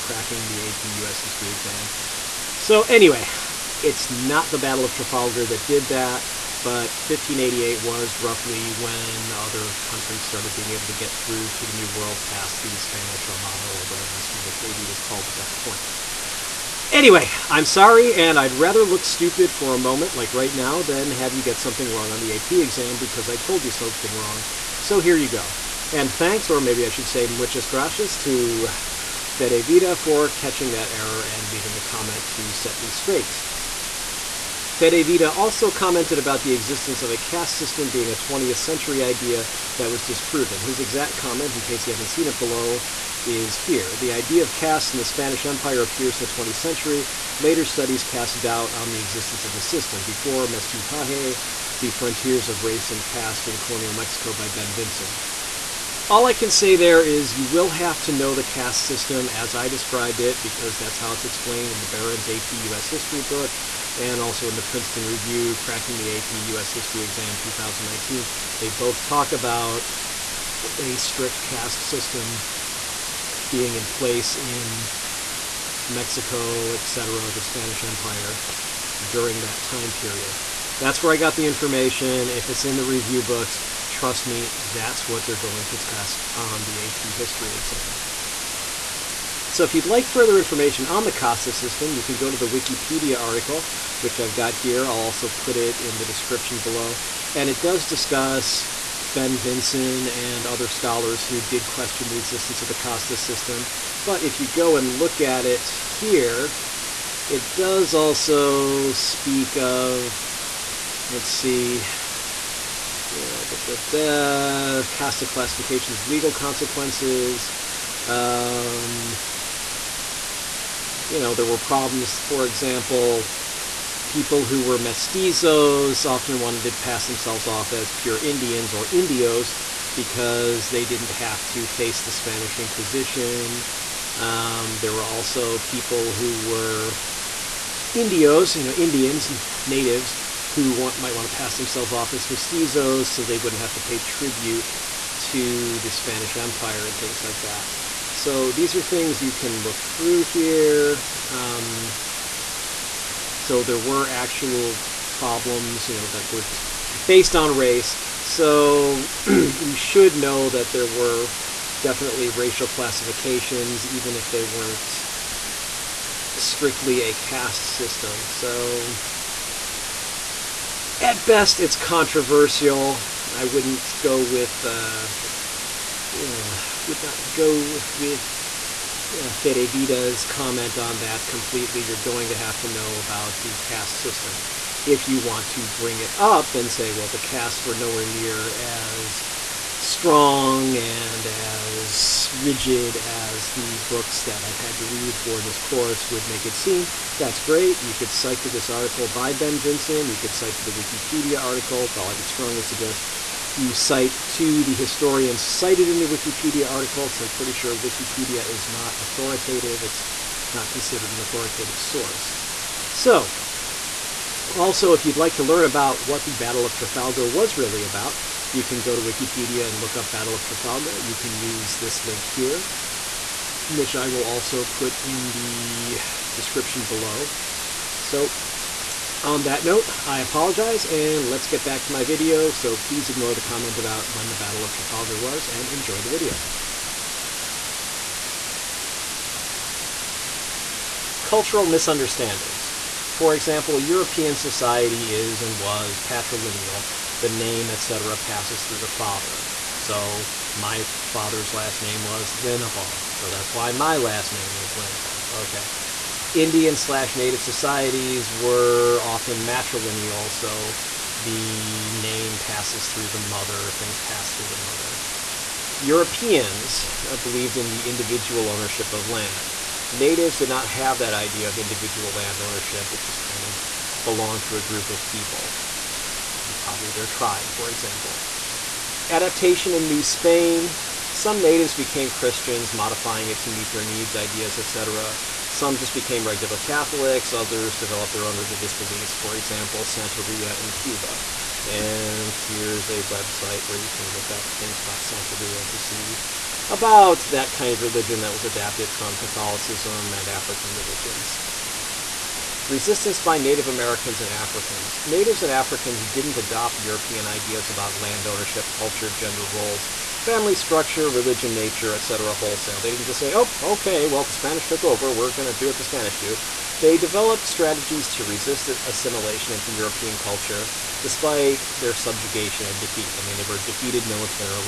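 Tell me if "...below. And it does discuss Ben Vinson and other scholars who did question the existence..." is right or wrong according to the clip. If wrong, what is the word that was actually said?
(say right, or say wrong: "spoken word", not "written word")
right.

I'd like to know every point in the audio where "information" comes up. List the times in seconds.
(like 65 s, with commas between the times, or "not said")
81 s, 90 s.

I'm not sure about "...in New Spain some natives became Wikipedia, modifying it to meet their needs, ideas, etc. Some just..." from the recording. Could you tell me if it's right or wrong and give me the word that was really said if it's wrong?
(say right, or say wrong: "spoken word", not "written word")
wrong: "Christians", not "Wikipedia".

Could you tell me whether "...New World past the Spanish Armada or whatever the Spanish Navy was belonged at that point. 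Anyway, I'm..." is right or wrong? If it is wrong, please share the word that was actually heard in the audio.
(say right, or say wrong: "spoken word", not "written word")
wrong: "called", not "belonged".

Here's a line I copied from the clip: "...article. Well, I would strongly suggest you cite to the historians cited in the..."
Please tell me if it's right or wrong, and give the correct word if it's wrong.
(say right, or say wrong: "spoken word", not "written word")
right.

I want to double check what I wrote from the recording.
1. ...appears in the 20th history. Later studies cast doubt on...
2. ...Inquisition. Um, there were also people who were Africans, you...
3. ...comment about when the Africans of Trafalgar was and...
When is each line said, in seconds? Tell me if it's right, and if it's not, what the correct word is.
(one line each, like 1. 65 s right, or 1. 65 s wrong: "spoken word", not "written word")
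1. 45 s wrong: "century", not "history"
2. 132 s wrong: "Indios", not "Africans"
3. 233 s wrong: "Battle", not "Africans".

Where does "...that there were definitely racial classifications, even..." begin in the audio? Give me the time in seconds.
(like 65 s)
160 s.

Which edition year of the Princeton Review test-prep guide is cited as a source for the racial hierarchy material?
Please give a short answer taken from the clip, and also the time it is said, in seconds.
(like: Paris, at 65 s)
2019, at 67 s.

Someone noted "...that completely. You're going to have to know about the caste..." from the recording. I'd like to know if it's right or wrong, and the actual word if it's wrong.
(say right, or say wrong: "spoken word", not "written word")
right.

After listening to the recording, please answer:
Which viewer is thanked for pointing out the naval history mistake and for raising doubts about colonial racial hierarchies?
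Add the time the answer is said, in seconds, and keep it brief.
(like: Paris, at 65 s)
Fedevita, at 29 s.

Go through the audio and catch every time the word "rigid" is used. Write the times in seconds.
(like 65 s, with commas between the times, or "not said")
192 s.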